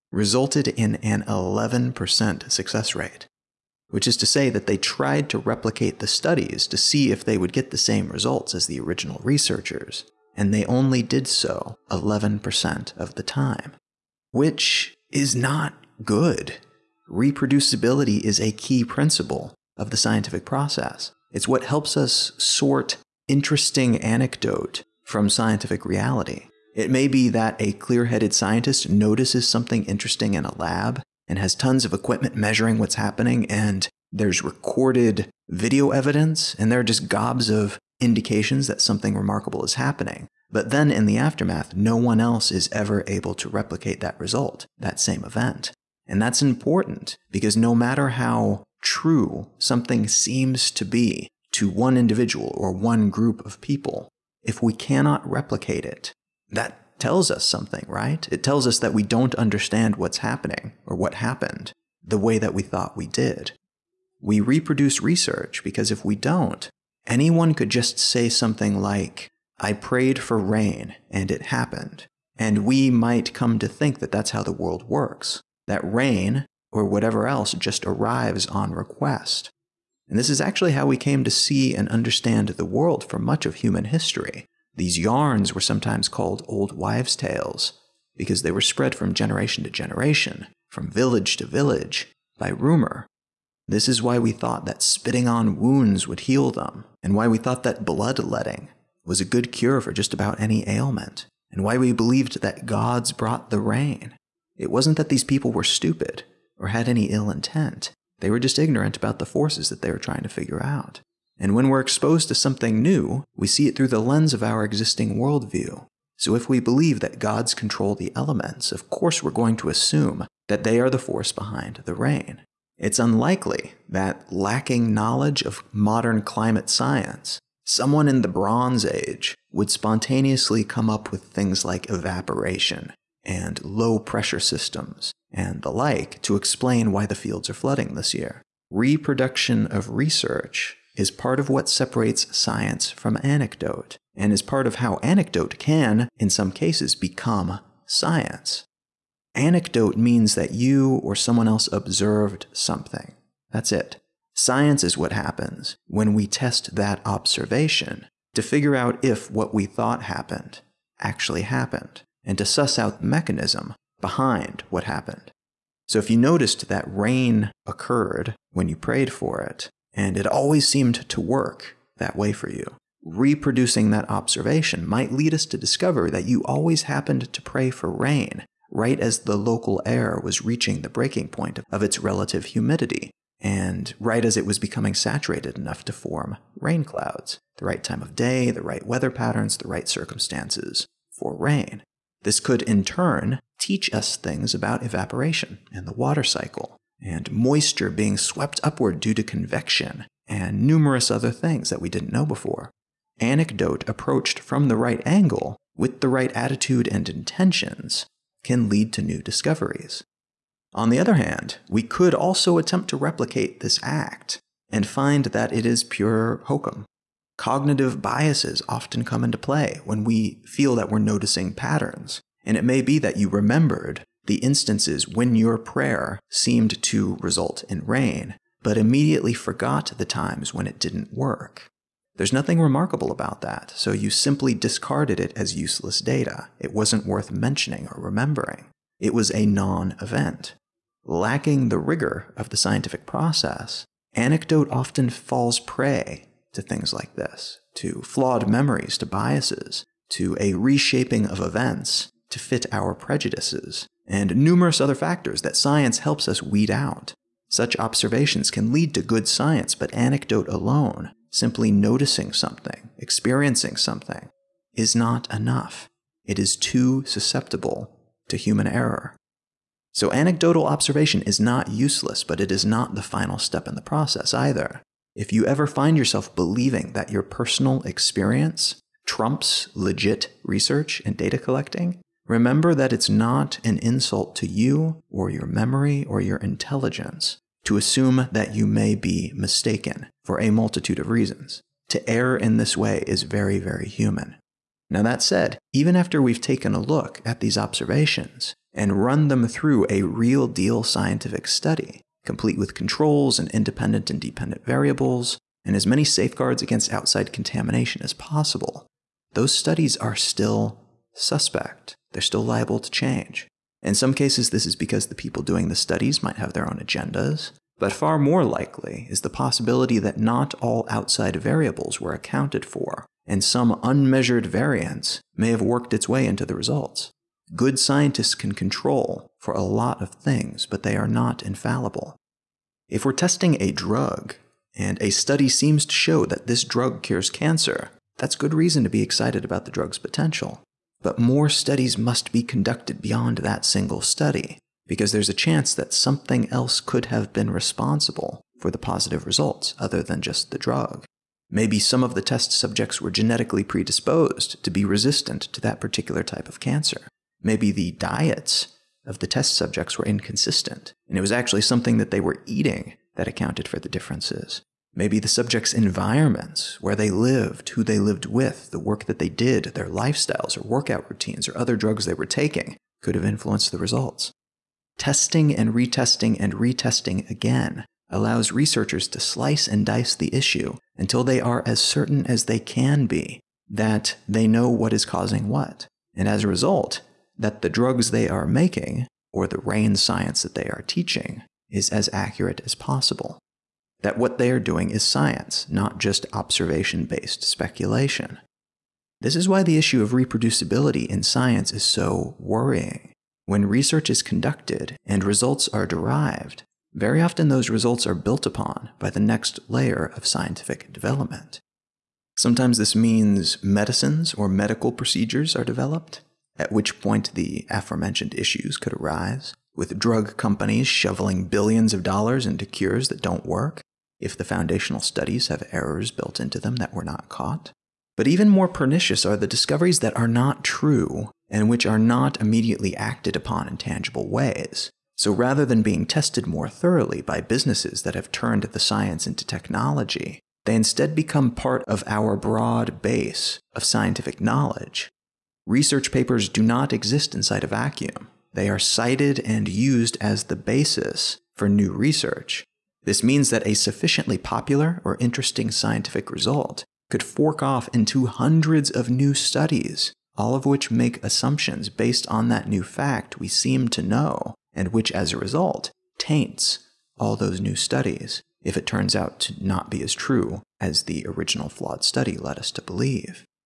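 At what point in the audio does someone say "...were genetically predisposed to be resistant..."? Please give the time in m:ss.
5:53.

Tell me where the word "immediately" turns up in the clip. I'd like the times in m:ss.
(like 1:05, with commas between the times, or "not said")
3:48, 7:12.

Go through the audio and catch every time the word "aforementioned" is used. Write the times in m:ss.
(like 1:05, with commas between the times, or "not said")
6:57.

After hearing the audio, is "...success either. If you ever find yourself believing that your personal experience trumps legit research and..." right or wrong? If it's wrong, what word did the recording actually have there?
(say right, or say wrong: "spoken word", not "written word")
wrong: "process", not "success".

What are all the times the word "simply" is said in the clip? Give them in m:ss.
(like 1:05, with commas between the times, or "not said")
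3:54, 4:21.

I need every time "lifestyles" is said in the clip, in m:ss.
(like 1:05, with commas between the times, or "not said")
6:09.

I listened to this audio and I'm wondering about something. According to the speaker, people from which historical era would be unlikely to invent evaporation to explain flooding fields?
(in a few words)
Bronze Age.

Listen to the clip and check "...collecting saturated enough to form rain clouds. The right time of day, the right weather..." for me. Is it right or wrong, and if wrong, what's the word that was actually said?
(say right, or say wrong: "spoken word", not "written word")
wrong: "becoming", not "collecting".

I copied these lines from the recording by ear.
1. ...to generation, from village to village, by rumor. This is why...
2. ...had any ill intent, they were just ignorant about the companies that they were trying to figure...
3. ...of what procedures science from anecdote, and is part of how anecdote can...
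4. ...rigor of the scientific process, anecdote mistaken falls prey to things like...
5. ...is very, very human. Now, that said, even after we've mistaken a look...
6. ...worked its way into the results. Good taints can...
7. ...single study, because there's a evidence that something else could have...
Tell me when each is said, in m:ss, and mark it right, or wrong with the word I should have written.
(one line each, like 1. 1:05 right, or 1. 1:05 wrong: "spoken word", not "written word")
1. 1:29 right
2. 1:46 wrong: "forces", not "companies"
3. 2:21 wrong: "separates", not "procedures"
4. 4:01 wrong: "often", not "mistaken"
5. 4:53 wrong: "taken", not "mistaken"
6. 5:25 wrong: "scientists", not "taints"
7. 5:43 wrong: "chance", not "evidence".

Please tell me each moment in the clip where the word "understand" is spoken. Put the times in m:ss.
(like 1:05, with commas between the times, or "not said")
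0:59, 1:21.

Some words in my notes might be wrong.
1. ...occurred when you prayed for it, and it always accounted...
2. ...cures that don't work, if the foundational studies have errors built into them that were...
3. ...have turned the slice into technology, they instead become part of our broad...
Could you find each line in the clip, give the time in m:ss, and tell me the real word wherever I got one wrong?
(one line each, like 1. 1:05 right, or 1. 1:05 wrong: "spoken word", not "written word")
1. 2:47 wrong: "seemed", not "accounted"
2. 7:02 right
3. 7:18 wrong: "science", not "slice".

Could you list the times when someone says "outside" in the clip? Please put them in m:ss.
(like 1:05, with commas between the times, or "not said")
5:06, 5:20.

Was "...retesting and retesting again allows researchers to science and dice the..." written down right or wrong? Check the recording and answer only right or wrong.
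wrong.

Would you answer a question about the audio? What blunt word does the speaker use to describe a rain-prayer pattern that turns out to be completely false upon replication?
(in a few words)
hokum.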